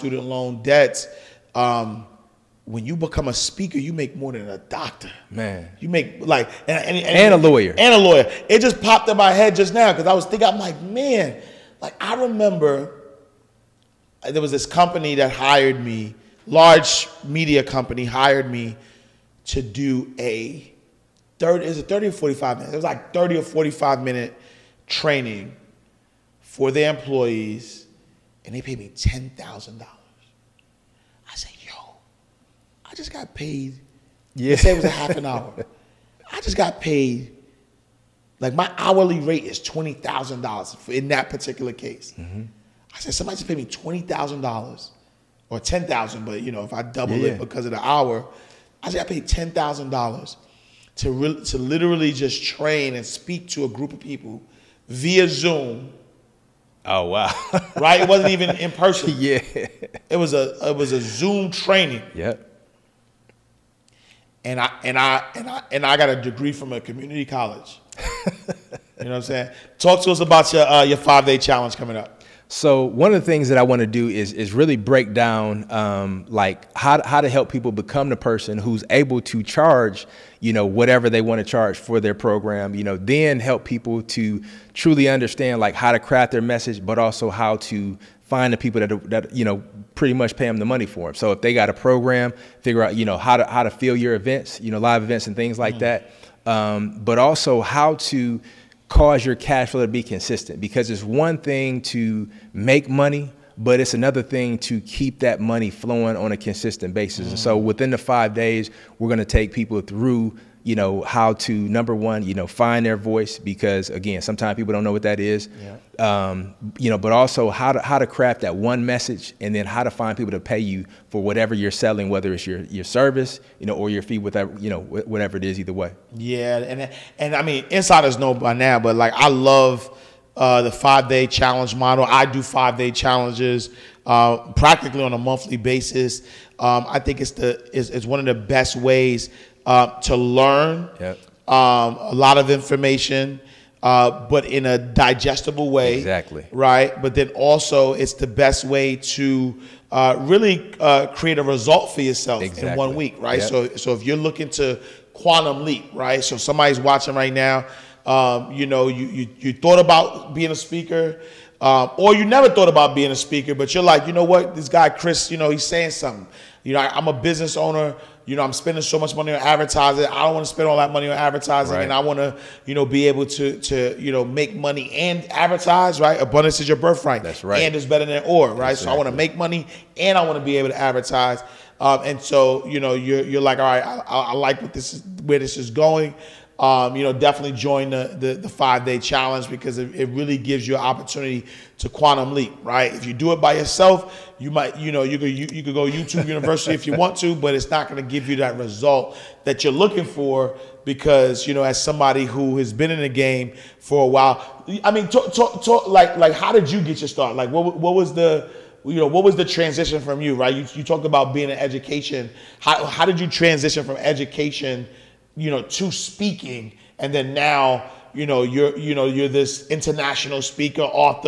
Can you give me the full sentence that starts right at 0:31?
I said, yo, I just got paid.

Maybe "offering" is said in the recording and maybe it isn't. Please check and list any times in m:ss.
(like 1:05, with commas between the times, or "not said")
not said.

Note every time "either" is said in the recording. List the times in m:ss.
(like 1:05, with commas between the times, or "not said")
2:05.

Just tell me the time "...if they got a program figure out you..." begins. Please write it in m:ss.
1:31.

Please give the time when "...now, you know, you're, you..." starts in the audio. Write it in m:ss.
3:37.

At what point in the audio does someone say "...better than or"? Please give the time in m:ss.
2:57.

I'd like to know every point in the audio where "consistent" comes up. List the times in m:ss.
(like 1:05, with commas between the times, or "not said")
1:40, 1:46.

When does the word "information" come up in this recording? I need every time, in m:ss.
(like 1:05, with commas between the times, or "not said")
2:22.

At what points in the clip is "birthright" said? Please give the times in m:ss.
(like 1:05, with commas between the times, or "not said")
2:56.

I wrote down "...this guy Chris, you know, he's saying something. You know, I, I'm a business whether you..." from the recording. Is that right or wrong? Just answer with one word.
wrong.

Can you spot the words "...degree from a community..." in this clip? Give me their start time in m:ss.
1:06.